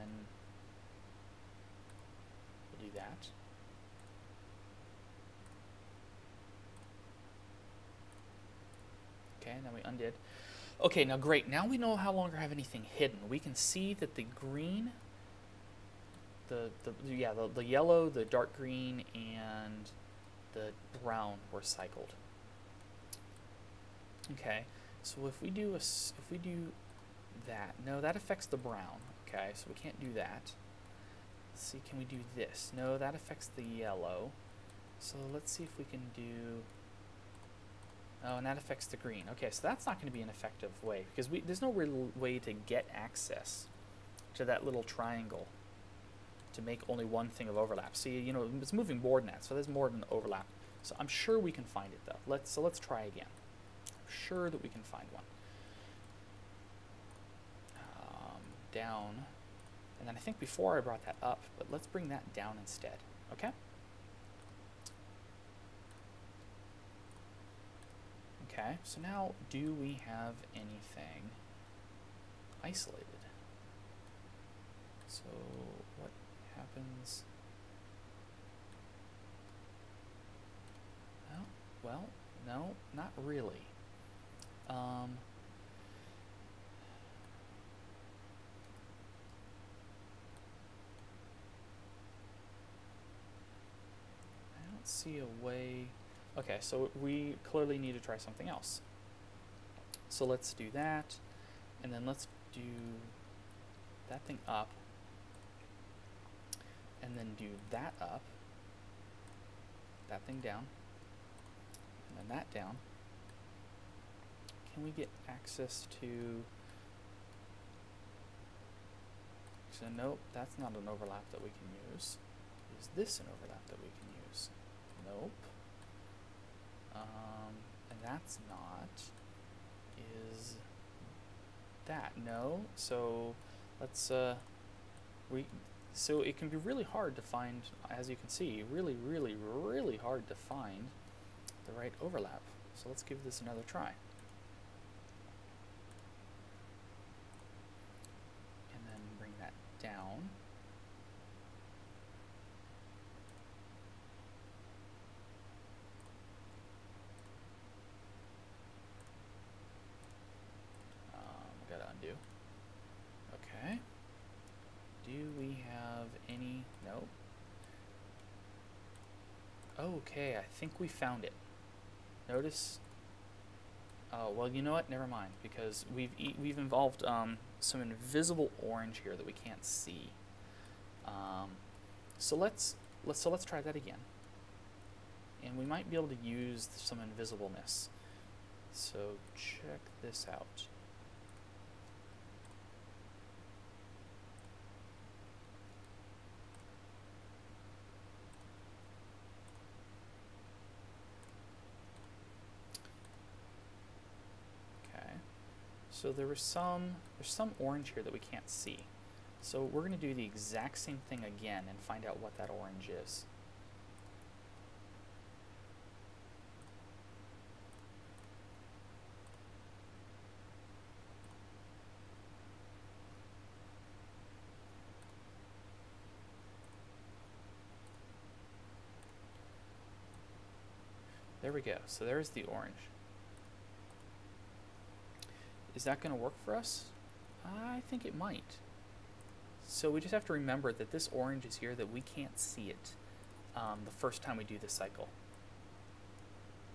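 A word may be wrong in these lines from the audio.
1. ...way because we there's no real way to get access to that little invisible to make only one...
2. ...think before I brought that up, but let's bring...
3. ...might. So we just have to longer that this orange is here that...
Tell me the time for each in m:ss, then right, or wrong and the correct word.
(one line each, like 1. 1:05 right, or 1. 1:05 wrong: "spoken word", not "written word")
1. 0:40 wrong: "triangle", not "invisible"
2. 1:00 right
3. 3:58 wrong: "remember", not "longer".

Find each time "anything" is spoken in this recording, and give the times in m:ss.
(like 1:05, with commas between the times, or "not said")
0:12, 1:10.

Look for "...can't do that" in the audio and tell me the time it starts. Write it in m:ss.
0:29.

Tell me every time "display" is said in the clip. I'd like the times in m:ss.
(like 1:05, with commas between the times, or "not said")
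not said.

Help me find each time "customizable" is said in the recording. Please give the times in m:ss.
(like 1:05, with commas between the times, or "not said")
not said.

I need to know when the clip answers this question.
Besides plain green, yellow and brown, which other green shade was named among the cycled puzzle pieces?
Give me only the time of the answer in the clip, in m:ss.
0:18.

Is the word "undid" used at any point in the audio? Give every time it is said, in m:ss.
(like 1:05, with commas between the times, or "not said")
0:09.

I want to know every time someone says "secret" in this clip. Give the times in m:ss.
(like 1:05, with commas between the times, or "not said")
not said.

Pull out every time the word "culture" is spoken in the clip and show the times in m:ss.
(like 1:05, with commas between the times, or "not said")
not said.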